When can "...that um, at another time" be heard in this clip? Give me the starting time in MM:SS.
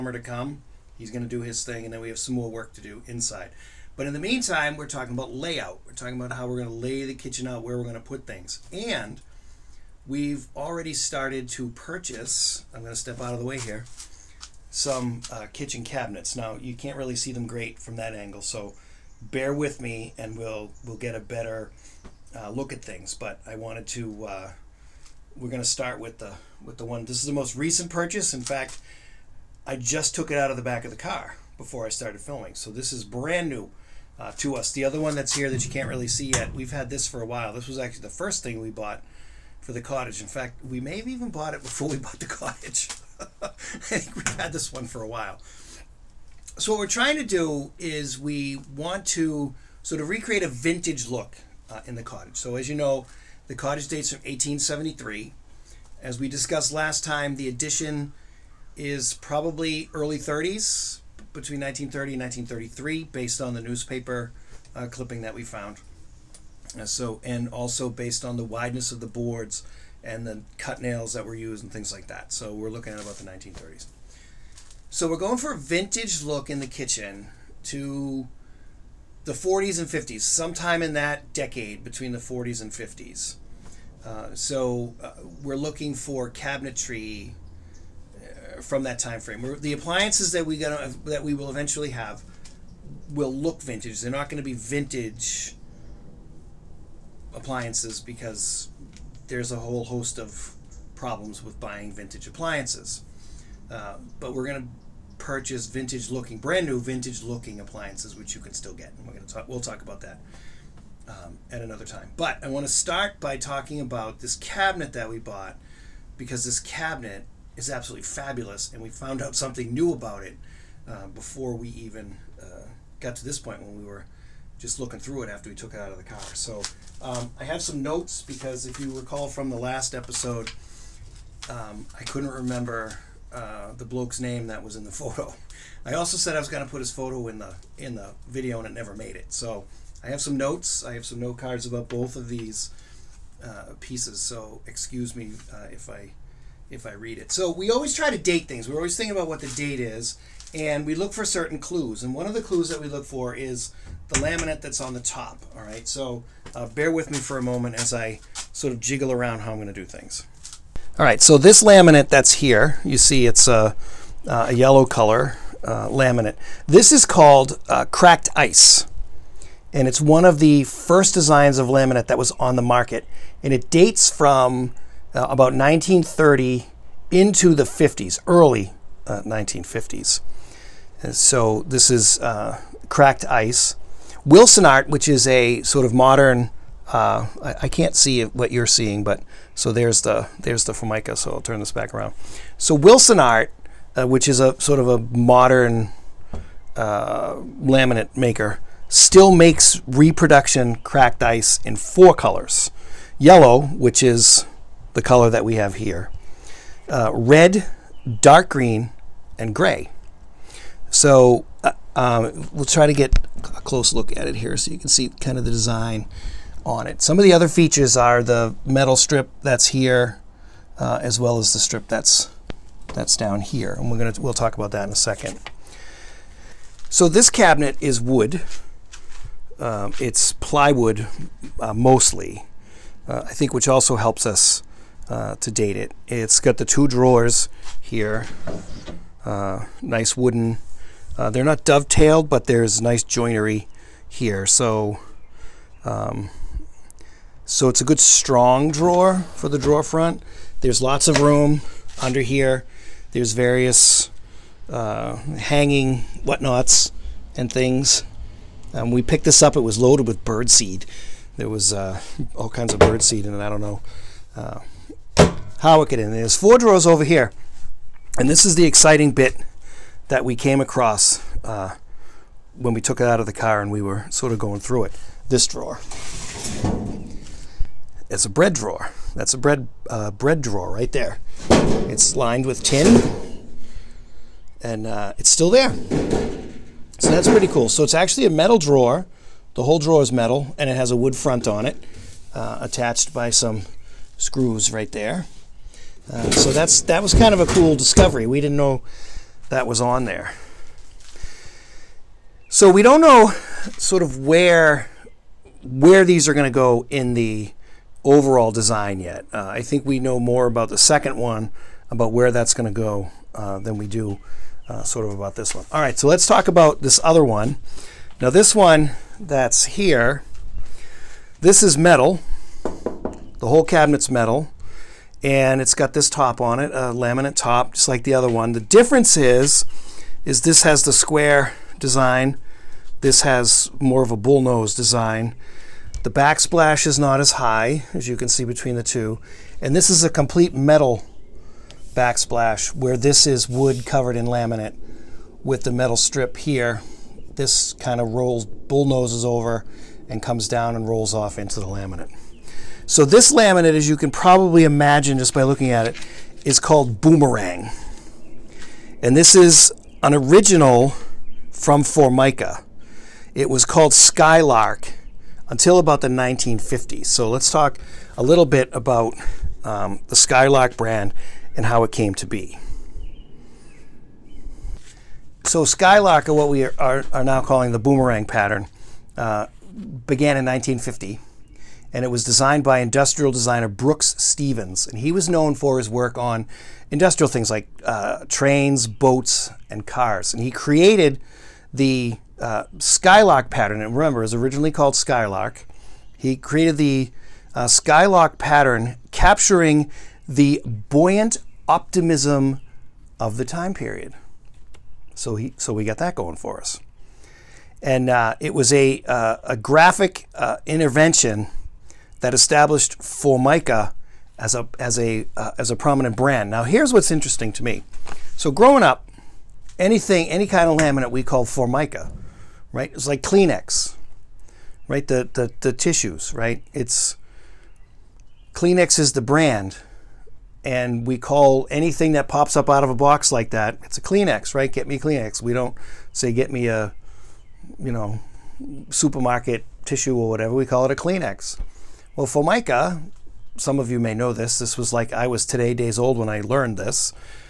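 01:50.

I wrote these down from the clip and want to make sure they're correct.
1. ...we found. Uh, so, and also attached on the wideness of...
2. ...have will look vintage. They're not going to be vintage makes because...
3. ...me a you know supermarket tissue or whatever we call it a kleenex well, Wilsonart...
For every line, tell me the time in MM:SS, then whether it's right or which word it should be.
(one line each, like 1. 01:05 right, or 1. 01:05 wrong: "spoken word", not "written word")
1. 01:05 wrong: "based", not "attached"
2. 01:31 wrong: "appliances", not "makes"
3. 07:16 wrong: "Formica", not "Wilsonart".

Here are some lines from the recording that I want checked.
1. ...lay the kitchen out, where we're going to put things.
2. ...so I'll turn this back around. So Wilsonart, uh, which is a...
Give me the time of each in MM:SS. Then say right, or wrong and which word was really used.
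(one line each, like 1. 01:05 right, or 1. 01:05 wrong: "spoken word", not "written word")
1. 00:06 right
2. 03:11 right.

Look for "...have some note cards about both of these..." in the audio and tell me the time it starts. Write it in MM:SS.
02:20.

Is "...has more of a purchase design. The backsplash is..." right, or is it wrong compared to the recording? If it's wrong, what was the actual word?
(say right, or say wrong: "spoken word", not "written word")
wrong: "bullnose", not "purchase".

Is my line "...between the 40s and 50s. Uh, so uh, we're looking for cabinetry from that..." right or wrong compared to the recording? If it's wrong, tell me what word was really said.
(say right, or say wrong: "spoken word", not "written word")
right.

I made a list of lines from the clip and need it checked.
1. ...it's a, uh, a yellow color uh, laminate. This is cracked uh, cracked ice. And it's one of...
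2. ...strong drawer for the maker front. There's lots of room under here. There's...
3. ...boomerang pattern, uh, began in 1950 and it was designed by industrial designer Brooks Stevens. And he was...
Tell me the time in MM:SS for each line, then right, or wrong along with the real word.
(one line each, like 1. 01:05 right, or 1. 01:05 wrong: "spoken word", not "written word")
1. 02:43 wrong: "called", not "cracked"
2. 04:07 wrong: "drawer", not "maker"
3. 06:17 right.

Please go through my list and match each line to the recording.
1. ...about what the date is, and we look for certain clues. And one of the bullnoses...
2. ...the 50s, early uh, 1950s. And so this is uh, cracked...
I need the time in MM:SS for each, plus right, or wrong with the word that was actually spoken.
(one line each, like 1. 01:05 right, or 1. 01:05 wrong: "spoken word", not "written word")
1. 02:29 wrong: "clues", not "bullnoses"
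2. 02:57 right.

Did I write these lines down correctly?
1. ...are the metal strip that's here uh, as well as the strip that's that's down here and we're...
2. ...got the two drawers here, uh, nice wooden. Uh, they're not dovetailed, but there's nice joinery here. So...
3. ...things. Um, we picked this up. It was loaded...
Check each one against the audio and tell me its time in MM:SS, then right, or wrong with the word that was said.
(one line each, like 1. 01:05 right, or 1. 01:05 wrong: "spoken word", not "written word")
1. 03:37 right
2. 03:56 right
3. 04:17 right.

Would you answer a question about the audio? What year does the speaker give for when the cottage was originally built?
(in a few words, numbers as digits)
1873.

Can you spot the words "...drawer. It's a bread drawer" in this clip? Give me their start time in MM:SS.
04:35.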